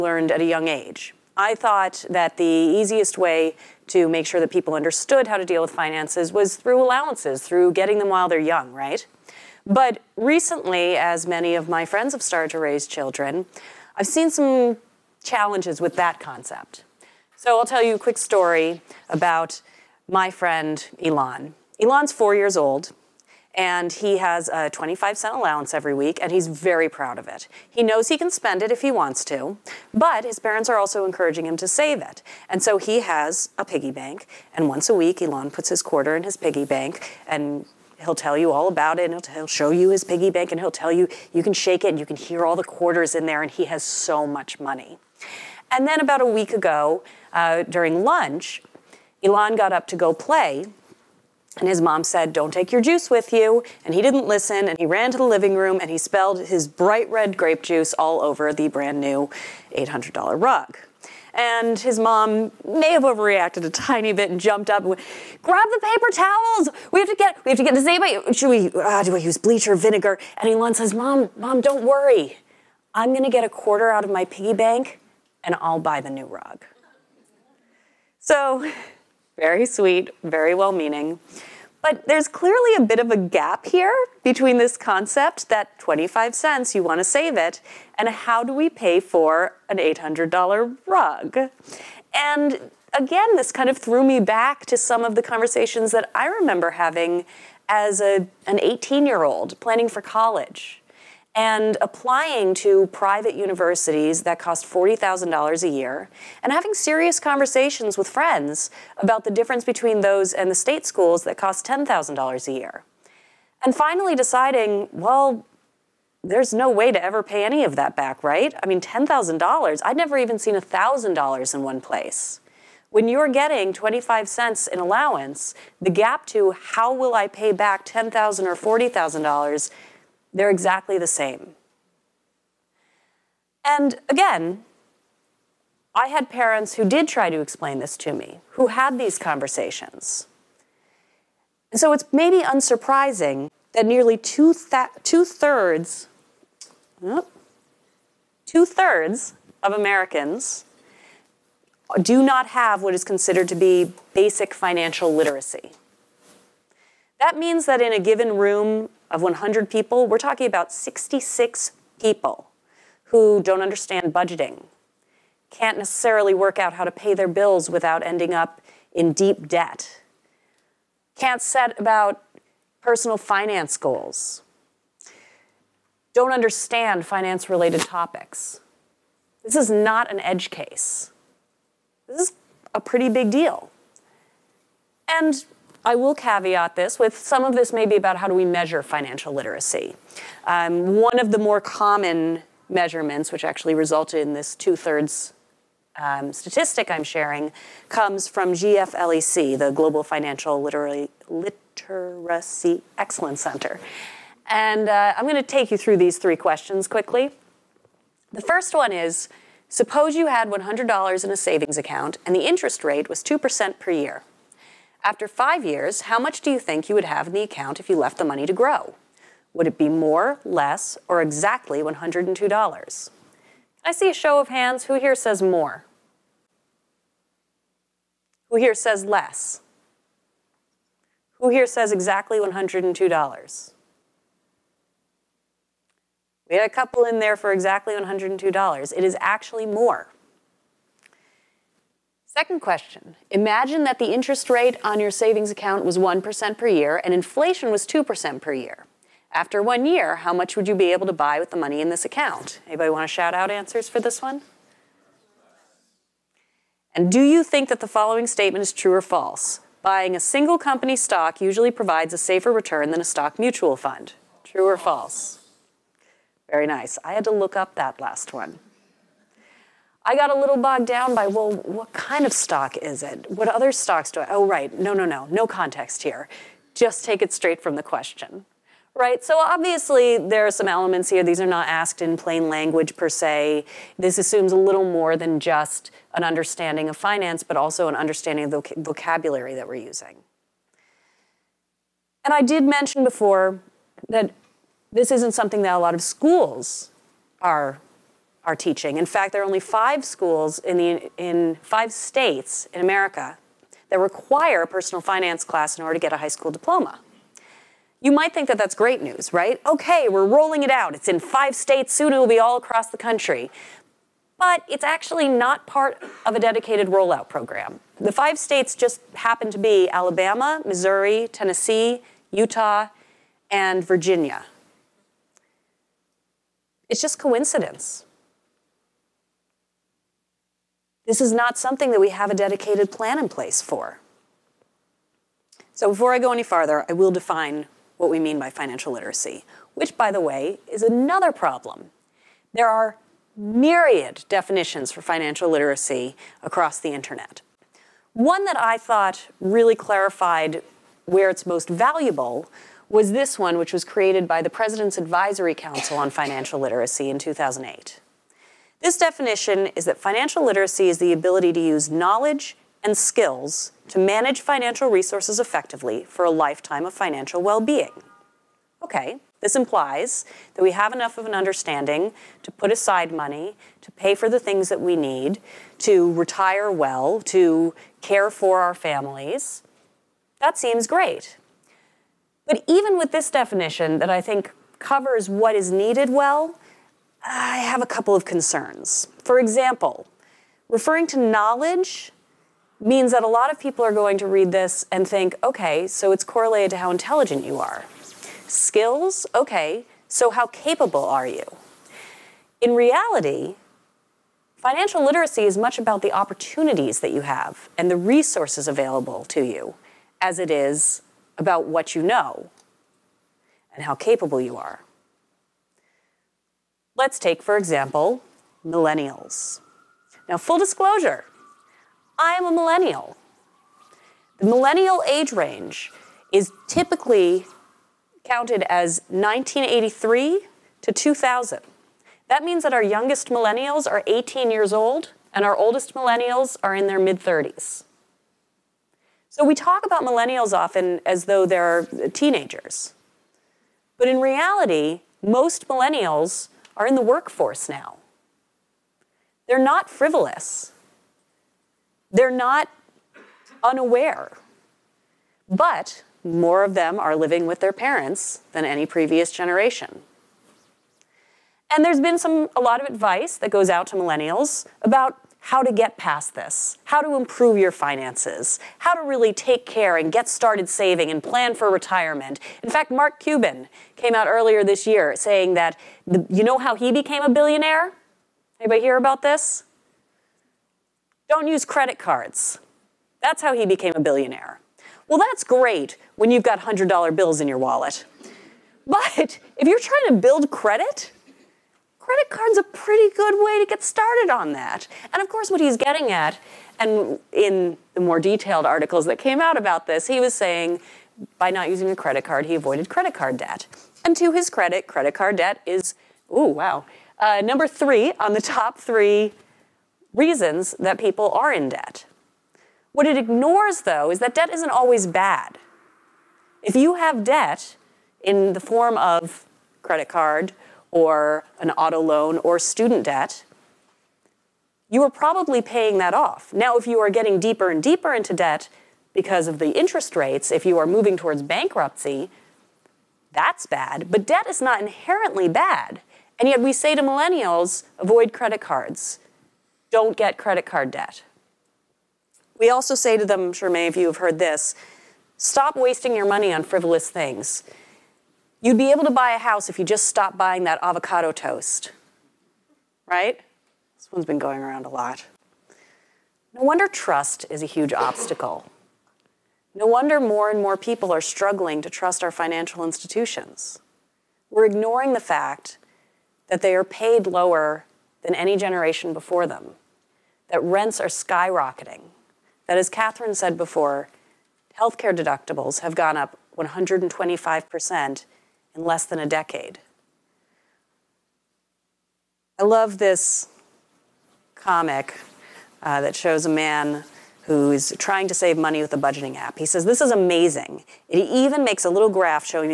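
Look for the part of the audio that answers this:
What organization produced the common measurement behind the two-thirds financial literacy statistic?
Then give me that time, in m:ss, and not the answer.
3:18.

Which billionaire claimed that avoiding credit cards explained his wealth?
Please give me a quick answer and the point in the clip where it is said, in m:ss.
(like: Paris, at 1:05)
Mark Cuban, at 7:52.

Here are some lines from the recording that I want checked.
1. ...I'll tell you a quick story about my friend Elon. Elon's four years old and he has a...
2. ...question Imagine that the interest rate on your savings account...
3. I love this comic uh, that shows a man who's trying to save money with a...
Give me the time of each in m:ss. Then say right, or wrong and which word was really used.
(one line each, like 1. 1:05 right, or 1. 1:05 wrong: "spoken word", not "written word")
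1. 0:17 right
2. 4:02 right
3. 9:42 right.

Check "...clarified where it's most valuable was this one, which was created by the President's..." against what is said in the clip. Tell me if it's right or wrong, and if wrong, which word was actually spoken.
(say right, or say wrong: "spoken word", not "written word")
right.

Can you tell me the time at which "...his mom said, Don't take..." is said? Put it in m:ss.
0:51.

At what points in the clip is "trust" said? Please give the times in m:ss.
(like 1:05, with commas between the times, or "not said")
9:16, 9:21.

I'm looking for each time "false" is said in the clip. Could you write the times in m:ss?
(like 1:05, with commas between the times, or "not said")
4:19, 4:24.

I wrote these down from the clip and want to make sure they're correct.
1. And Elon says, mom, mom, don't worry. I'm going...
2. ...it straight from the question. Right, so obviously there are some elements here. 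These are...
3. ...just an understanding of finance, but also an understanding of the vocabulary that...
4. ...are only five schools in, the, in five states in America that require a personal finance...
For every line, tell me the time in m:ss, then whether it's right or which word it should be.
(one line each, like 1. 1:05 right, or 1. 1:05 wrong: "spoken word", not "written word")
1. 1:10 right
2. 4:37 right
3. 4:45 right
4. 4:59 right.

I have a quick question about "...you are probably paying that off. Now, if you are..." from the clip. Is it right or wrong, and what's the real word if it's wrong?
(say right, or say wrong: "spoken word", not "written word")
right.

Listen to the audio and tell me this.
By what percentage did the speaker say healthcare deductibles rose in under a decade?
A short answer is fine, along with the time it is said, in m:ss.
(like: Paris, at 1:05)
125%, at 9:36.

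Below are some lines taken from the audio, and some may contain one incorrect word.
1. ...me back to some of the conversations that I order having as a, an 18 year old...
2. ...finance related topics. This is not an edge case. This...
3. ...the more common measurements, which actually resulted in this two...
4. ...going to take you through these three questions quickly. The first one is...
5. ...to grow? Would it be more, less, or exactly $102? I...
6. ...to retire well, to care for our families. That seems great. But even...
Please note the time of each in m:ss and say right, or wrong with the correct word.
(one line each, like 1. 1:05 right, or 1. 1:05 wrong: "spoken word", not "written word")
1. 1:34 wrong: "remember", not "order"
2. 2:57 right
3. 3:11 right
4. 3:25 right
5. 3:38 right
6. 6:15 right.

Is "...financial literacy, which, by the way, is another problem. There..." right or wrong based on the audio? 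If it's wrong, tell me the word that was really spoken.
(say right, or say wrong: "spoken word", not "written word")
right.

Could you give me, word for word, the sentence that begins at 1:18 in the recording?
So very sweet, very well meaning.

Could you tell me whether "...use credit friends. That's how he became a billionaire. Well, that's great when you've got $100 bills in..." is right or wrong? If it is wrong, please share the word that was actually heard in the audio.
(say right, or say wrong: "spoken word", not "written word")
wrong: "cards", not "friends".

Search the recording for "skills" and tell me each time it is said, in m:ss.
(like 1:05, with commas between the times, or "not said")
6:02, 6:38.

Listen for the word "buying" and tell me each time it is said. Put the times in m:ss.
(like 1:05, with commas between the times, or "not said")
4:19, 9:10.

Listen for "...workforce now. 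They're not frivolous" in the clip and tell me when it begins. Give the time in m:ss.
7:27.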